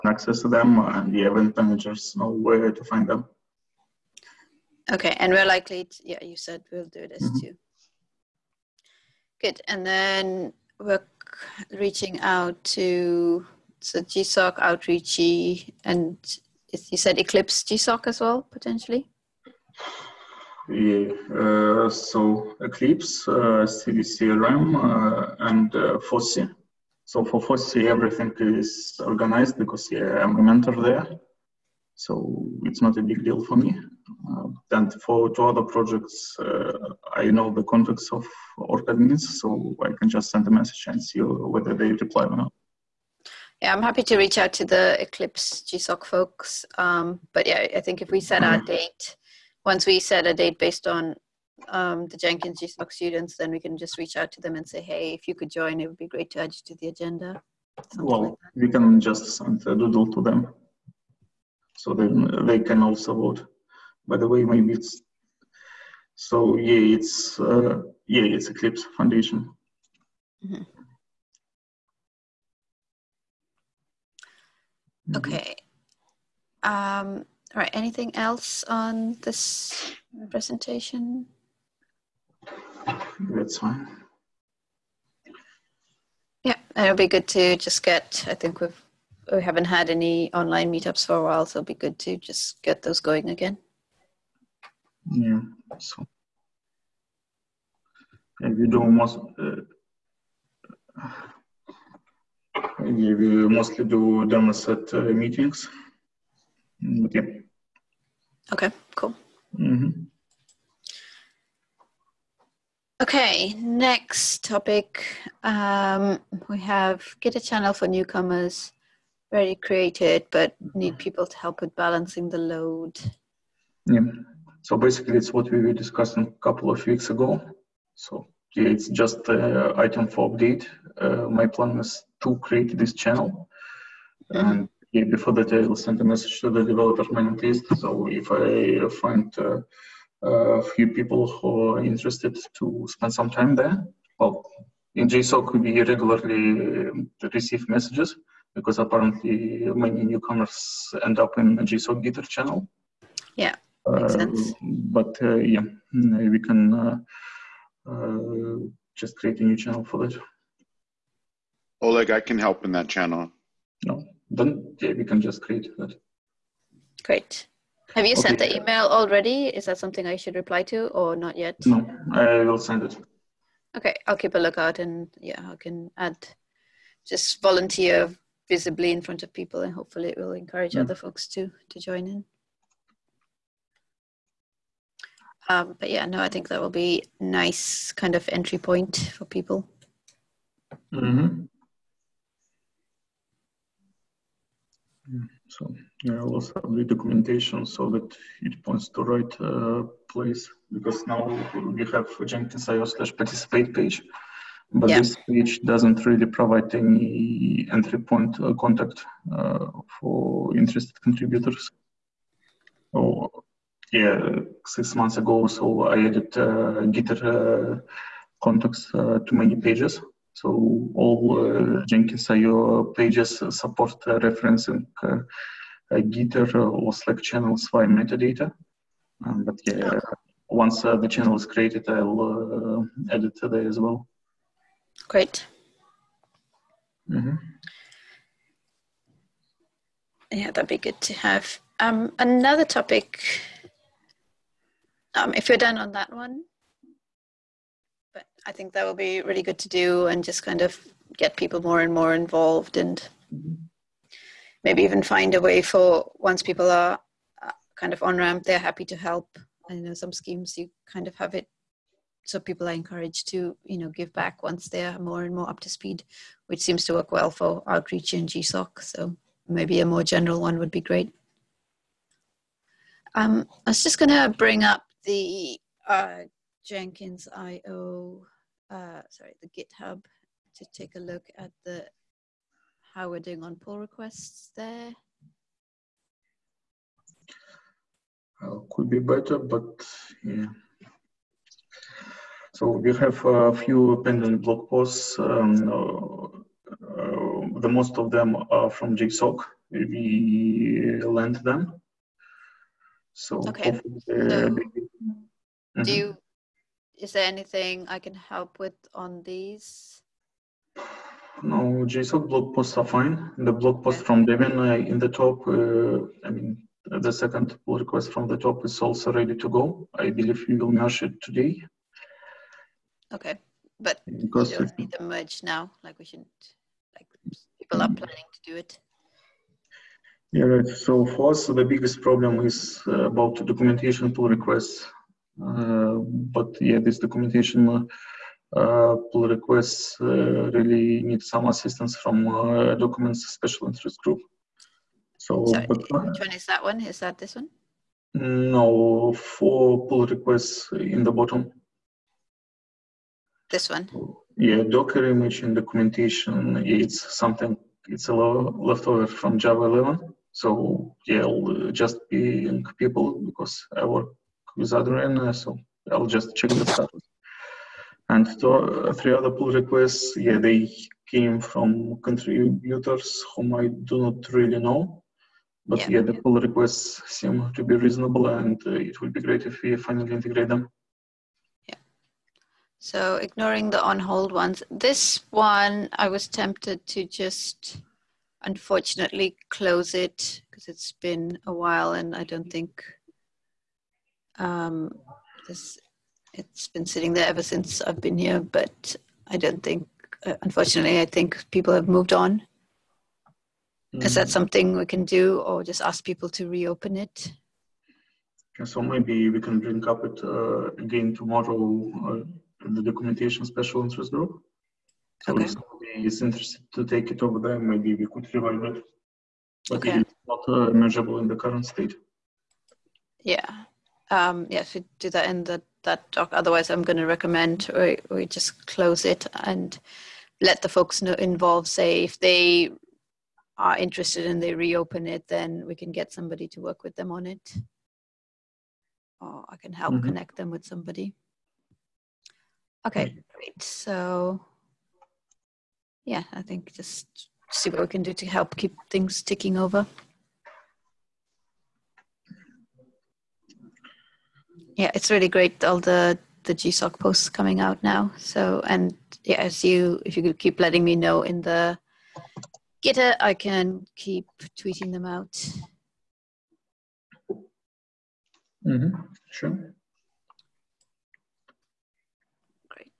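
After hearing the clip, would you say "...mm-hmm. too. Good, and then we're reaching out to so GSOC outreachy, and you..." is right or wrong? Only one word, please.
right.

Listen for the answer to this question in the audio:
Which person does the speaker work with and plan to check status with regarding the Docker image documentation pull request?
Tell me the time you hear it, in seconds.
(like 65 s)
364 s.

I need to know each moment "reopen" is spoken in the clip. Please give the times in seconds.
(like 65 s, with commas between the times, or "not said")
406 s, 434 s.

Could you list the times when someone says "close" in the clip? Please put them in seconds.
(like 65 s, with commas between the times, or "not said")
389 s, 428 s.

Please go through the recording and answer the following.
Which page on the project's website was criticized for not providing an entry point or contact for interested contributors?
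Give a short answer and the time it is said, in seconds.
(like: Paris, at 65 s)
participate page, at 203 s.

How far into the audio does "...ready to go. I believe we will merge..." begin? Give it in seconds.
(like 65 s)
319 s.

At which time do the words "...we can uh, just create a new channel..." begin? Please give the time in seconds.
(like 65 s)
155 s.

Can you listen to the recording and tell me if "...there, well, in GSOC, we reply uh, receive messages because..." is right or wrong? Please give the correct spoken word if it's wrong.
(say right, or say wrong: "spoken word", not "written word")
wrong: "regularly", not "reply".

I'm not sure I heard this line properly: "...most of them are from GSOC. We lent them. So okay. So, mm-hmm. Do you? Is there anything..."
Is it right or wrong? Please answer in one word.
right.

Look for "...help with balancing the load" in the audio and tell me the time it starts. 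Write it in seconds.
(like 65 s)
121 s.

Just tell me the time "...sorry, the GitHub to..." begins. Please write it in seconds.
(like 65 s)
279 s.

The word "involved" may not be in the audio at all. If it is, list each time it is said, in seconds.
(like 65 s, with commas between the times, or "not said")
252 s, 431 s.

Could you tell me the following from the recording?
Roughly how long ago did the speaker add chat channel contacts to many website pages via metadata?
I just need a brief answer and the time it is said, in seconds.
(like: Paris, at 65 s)
six months, at 214 s.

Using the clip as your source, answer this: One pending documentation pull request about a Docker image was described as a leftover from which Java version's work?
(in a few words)
Java 11.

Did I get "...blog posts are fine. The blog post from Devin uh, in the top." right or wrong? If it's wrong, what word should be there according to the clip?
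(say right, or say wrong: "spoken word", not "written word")
right.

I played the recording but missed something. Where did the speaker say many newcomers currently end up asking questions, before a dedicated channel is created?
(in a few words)
GSOC Gitter channel.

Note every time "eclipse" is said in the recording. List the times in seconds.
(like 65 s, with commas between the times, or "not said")
17 s, 22 s, 45 s, 68 s.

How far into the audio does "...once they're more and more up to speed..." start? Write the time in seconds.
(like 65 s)
264 s.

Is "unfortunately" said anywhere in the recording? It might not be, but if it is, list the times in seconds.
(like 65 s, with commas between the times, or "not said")
388 s, 400 s.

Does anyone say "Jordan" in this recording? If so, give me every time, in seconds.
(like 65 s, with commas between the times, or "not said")
not said.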